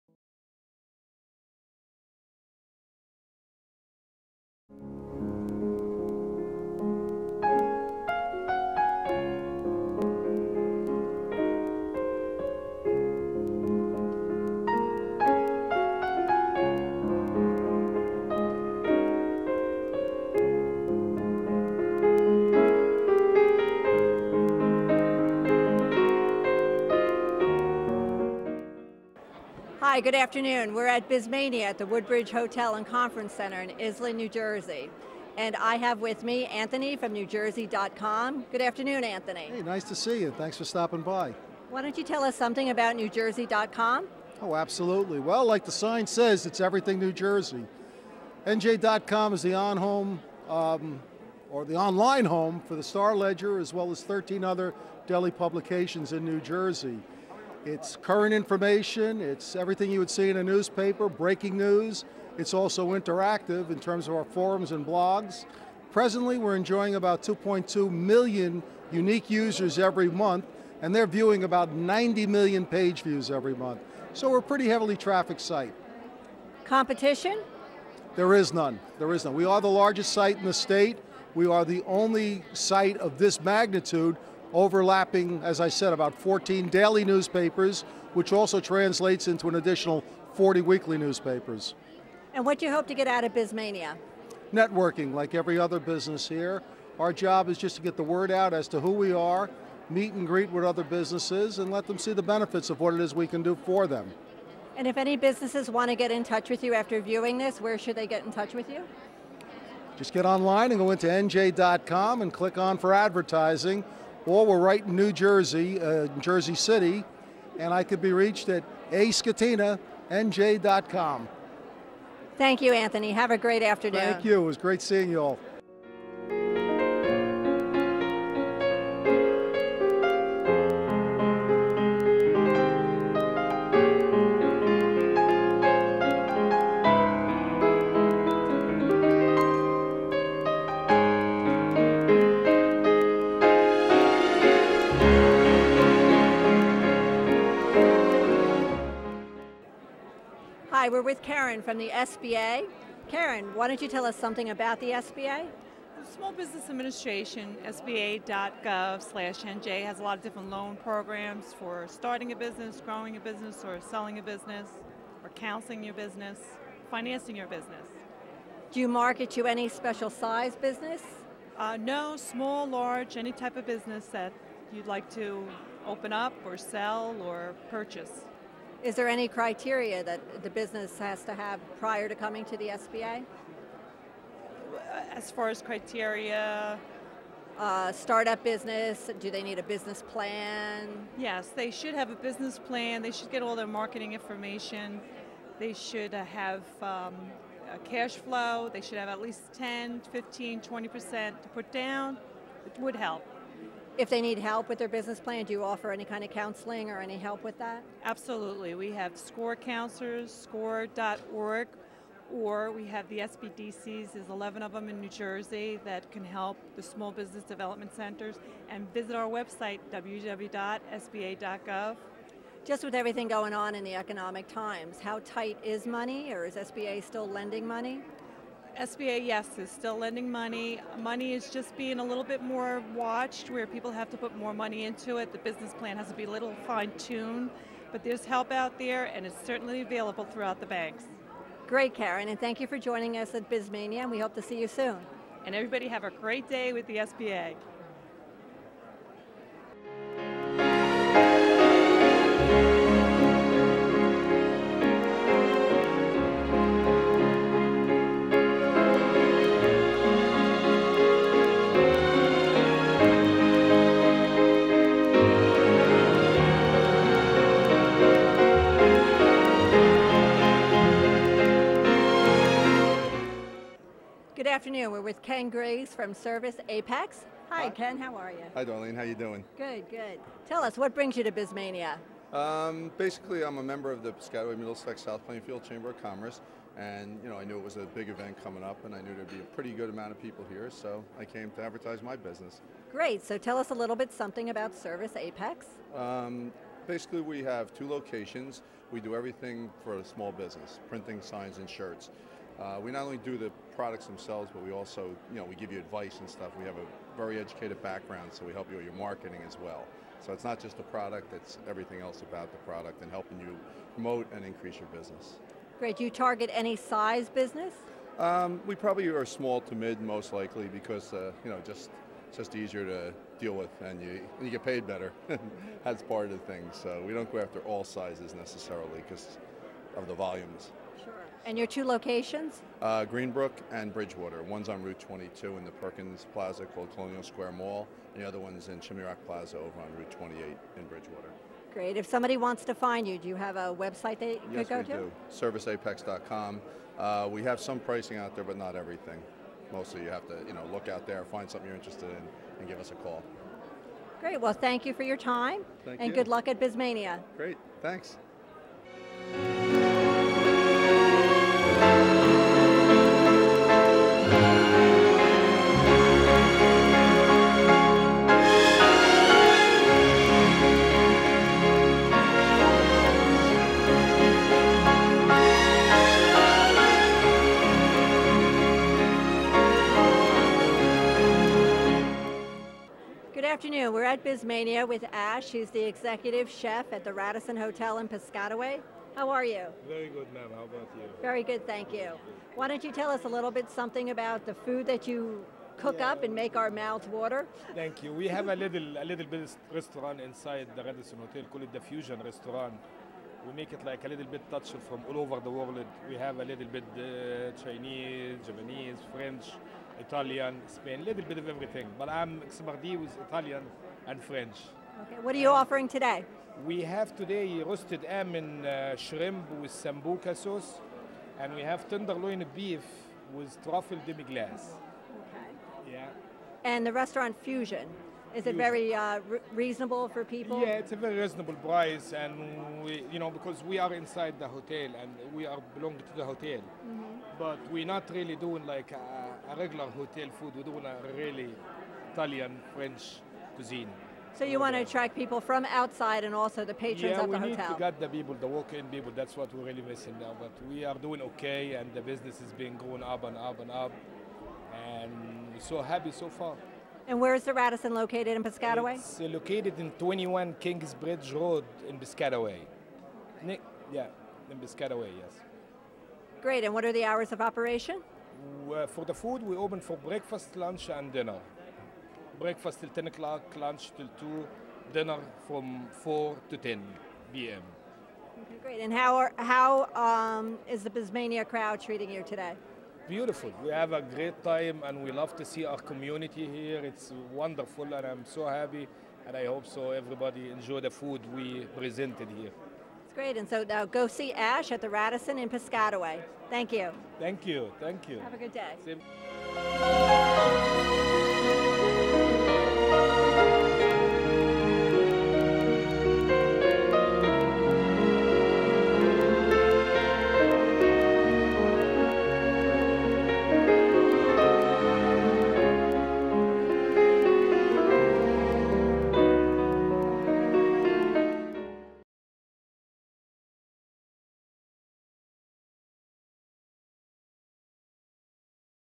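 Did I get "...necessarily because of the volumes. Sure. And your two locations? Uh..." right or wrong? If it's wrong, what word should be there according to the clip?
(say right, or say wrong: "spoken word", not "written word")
right.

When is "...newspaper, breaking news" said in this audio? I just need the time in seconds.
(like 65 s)
60 s.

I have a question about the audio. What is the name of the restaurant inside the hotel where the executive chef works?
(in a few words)
Fusion Restaurant.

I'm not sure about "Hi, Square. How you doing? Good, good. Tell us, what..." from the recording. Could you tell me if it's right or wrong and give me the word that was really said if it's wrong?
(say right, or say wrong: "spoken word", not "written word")
wrong: "Darlene", not "Square".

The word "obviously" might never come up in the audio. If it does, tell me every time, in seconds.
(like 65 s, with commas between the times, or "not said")
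not said.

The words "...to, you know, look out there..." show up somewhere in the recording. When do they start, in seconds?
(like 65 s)
350 s.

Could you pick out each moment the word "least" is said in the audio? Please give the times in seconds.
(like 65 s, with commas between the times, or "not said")
199 s.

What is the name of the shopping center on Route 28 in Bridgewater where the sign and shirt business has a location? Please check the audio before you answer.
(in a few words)
Chimney Rock Plaza.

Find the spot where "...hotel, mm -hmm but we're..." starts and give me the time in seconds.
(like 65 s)
436 s.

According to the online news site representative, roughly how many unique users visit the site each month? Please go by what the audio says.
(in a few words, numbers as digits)
2.2 million.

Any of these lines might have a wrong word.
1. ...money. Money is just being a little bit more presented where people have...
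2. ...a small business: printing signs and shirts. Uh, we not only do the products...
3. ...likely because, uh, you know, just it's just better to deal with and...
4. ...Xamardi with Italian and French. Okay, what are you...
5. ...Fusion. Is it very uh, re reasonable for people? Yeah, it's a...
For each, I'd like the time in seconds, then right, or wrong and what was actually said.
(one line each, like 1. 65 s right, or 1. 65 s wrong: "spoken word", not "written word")
1. 230 s wrong: "watched", not "presented"
2. 299 s right
3. 320 s wrong: "easier", not "better"
4. 412 s right
5. 427 s right.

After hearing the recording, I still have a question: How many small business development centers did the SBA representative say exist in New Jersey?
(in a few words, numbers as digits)
11.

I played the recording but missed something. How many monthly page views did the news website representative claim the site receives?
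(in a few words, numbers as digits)
90 million.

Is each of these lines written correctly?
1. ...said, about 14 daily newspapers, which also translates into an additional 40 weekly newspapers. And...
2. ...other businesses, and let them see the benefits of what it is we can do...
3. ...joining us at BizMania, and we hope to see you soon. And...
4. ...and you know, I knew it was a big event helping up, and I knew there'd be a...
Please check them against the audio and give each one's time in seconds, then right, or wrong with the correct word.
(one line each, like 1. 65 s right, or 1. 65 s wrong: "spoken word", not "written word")
1. 85 s right
2. 100 s right
3. 242 s right
4. 286 s wrong: "coming", not "helping".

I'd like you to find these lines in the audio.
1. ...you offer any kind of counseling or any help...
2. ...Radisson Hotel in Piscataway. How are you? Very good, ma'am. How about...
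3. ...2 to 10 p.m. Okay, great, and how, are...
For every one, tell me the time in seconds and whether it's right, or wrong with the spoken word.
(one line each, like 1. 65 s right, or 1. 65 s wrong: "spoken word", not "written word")
1. 205 s right
2. 387 s right
3. 476 s wrong: "4", not "2".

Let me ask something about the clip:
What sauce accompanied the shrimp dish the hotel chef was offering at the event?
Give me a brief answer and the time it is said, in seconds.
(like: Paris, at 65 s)
sambuca sauce, at 419 s.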